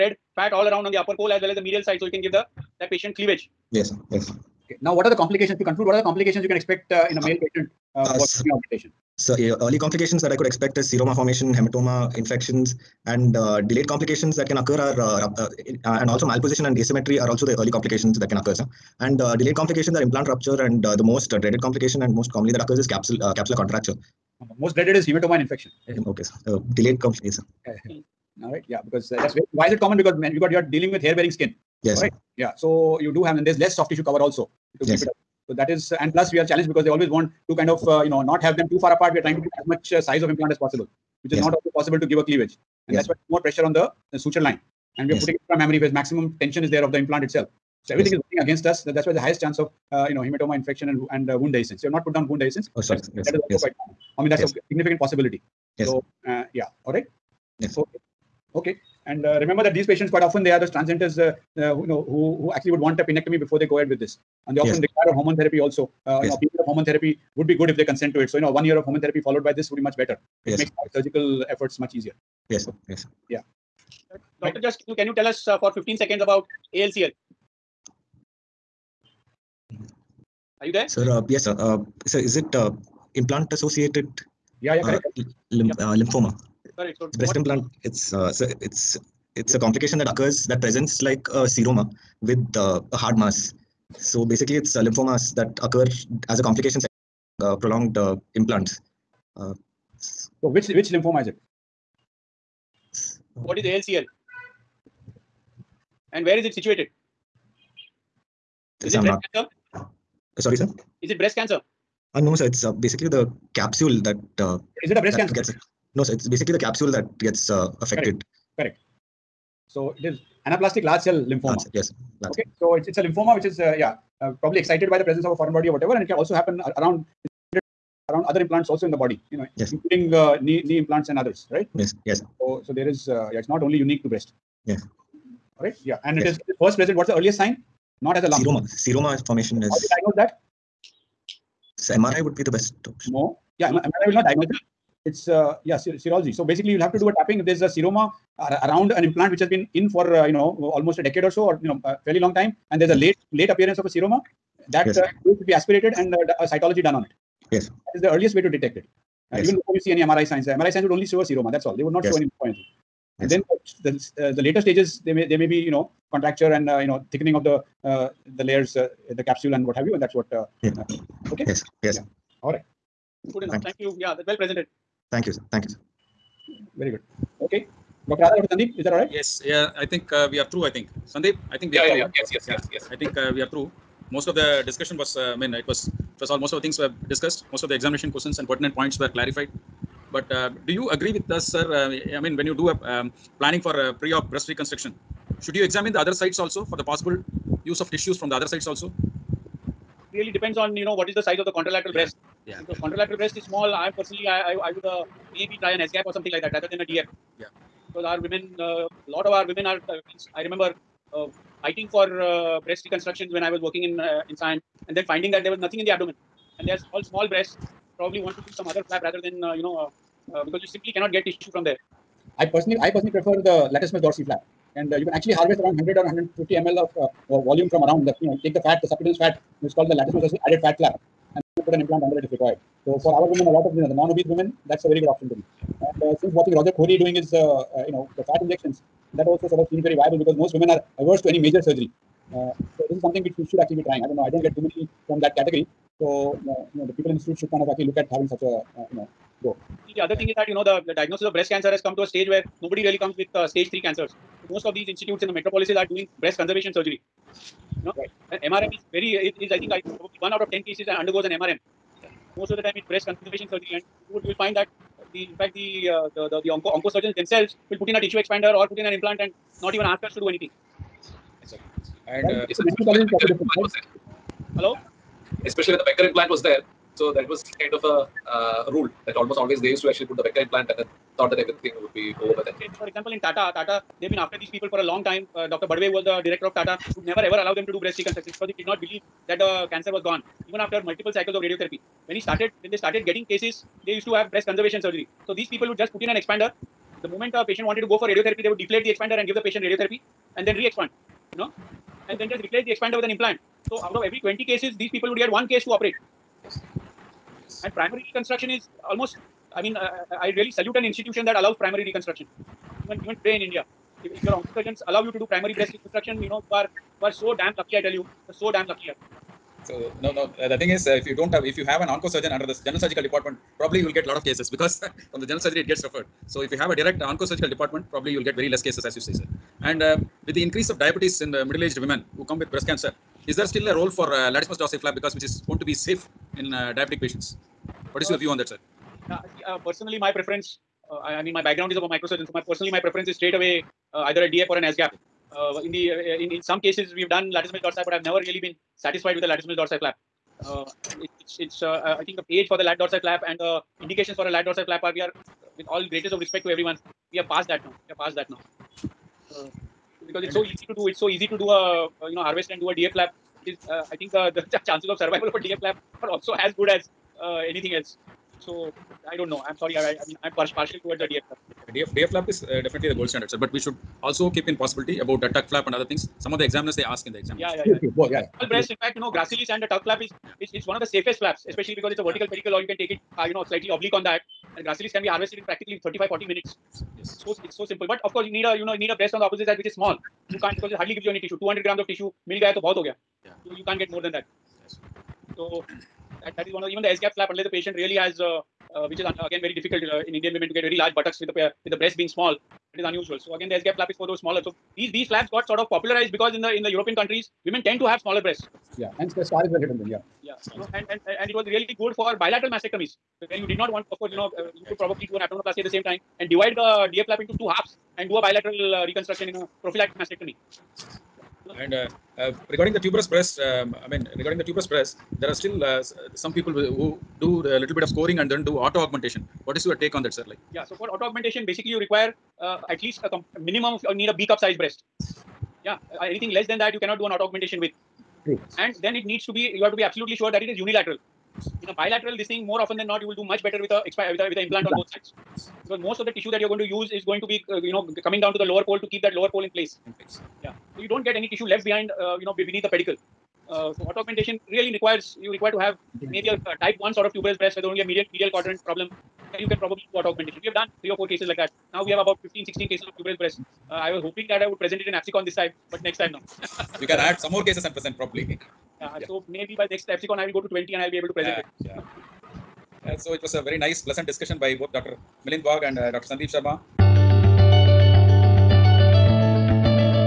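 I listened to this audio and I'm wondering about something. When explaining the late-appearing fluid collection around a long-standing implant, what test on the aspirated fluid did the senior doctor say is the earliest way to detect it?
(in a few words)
cytology.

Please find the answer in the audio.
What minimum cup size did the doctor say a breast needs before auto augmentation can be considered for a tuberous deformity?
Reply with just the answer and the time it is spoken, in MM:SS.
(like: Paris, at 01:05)
B cup, at 07:14.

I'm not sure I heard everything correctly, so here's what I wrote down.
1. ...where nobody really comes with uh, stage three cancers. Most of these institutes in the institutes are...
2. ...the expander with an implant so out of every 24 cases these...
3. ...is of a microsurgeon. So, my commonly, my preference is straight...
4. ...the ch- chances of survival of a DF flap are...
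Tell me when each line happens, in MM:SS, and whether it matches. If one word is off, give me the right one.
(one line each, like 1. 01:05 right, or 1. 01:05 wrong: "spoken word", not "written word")
1. 04:12 wrong: "metropolises", not "institutes"
2. 05:02 wrong: "20", not "24"
3. 05:41 wrong: "personally", not "commonly"
4. 06:04 right.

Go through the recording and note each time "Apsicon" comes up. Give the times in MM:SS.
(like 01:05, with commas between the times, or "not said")
07:44, 07:49.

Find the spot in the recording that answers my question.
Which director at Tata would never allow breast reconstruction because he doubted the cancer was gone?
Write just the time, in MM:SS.
04:45.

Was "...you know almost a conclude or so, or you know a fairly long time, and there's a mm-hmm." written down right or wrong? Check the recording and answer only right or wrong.
wrong.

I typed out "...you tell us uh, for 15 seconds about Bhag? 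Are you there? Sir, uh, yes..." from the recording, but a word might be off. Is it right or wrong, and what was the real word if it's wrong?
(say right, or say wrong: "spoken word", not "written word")
wrong: "ALCL", not "Bhag".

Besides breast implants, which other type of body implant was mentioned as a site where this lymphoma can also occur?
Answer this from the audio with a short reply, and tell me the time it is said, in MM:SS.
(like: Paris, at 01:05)
knee implants, at 02:10.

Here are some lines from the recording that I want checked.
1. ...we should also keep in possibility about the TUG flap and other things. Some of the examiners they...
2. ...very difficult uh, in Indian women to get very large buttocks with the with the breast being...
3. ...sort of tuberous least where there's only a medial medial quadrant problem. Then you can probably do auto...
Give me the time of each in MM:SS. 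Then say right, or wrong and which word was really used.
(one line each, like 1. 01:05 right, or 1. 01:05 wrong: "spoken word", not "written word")
1. 06:13 right
2. 06:39 right
3. 07:36 wrong: "breast", not "least".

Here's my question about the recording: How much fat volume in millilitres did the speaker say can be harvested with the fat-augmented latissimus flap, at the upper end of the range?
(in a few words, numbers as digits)
150 ml.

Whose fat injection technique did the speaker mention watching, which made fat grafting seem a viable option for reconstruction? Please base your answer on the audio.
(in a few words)
Roger Khouri.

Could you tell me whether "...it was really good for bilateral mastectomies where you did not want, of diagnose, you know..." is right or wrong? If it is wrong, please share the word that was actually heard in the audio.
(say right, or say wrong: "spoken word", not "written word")
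wrong: "course", not "diagnose".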